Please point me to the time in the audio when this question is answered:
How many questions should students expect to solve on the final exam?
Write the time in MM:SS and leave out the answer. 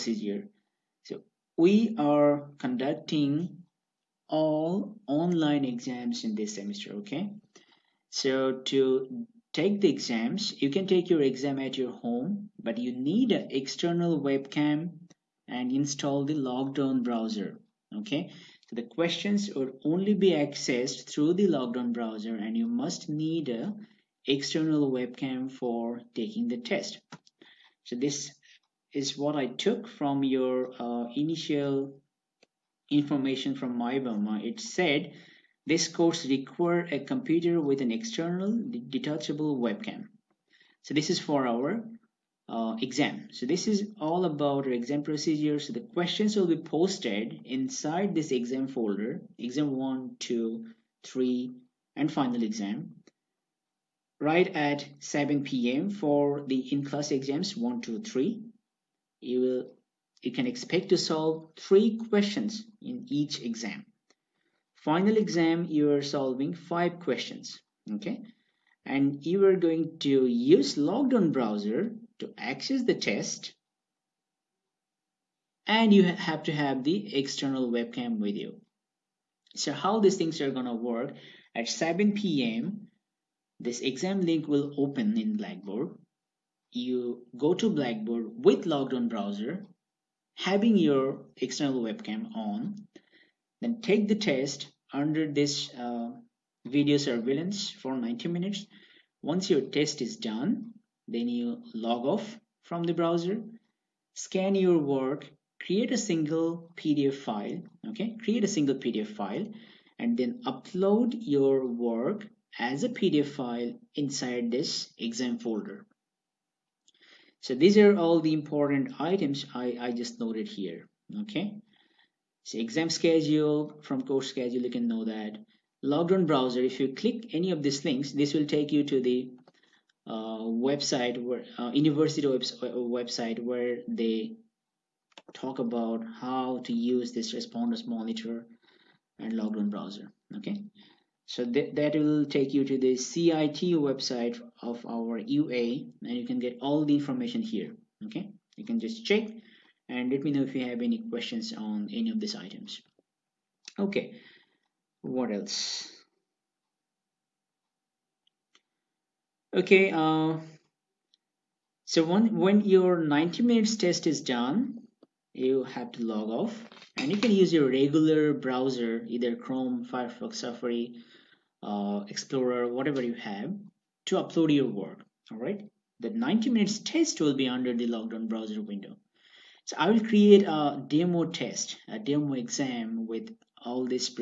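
01:06.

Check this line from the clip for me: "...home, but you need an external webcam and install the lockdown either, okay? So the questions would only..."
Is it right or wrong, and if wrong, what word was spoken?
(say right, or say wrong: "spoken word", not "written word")
wrong: "browser", not "either".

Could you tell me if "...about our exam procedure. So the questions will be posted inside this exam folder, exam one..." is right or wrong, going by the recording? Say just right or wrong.
right.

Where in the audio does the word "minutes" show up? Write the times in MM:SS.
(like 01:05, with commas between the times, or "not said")
01:38, 02:43, 02:56.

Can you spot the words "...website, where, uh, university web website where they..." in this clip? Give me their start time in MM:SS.
02:10.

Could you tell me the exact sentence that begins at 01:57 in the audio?
So these are all the important items I, I just noted here.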